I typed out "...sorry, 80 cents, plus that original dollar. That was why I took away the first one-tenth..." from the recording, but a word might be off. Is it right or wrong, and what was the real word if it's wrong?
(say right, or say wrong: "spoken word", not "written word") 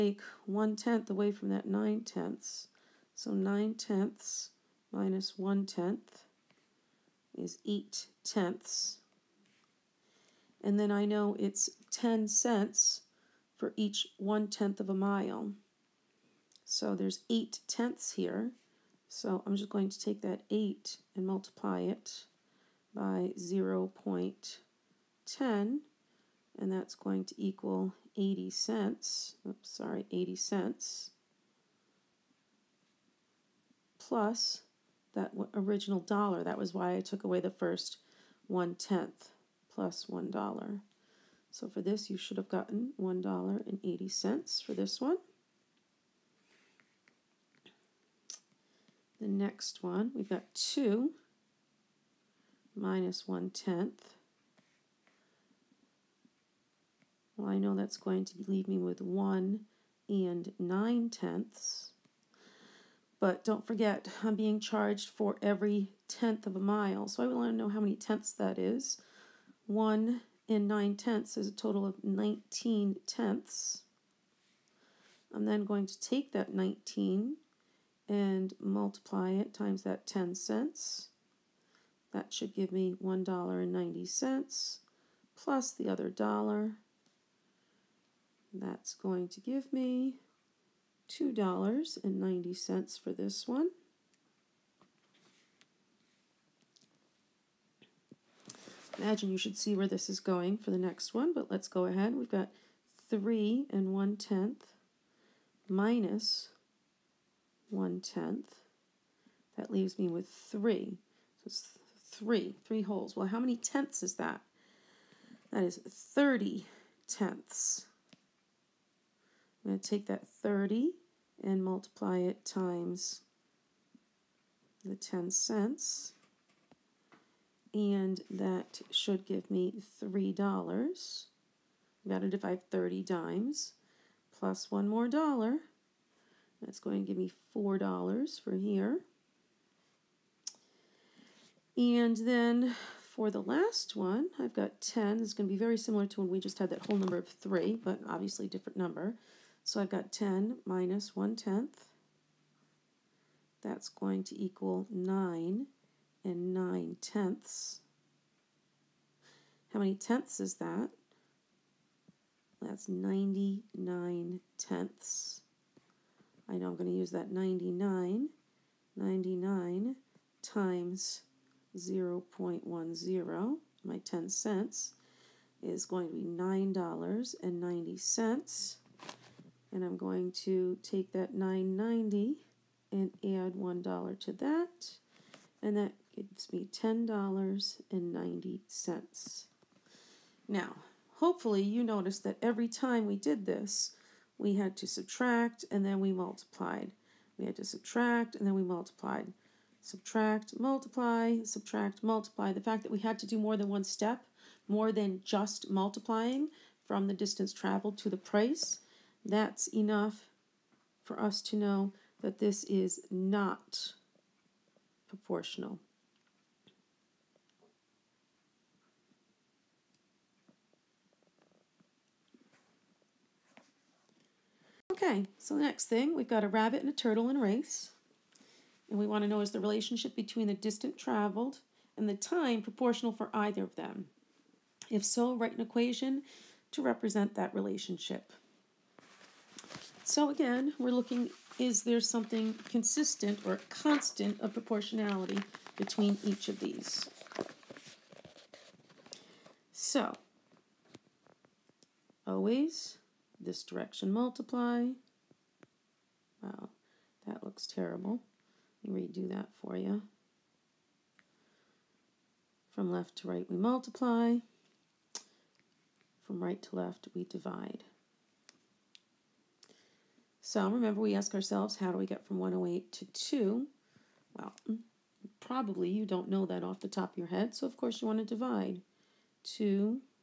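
right.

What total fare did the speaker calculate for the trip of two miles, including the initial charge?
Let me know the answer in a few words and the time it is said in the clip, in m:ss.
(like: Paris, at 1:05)
$2.90, at 1:31.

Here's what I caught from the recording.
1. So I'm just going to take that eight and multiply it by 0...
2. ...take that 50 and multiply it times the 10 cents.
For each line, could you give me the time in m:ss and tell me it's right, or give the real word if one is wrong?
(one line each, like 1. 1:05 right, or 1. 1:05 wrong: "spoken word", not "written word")
1. 0:19 right
2. 1:59 wrong: "30", not "50".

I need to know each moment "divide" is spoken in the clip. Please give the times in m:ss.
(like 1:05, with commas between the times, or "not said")
2:12, 4:27, 4:38.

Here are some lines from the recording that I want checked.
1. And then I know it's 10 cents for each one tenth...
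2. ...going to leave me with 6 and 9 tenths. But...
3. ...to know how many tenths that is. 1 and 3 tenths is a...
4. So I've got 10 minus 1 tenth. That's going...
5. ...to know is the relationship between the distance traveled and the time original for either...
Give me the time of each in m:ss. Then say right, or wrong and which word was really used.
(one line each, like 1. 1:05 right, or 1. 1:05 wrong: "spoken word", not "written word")
1. 0:10 right
2. 0:57 wrong: "1", not "6"
3. 1:07 wrong: "9", not "3"
4. 2:29 right
5. 3:49 wrong: "proportional", not "original".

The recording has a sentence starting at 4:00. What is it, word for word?
So again, we're looking, is there something consistent or constant of proportionality between each of these?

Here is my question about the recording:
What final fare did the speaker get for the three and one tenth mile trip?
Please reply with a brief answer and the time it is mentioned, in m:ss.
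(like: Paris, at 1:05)
$4, at 2:17.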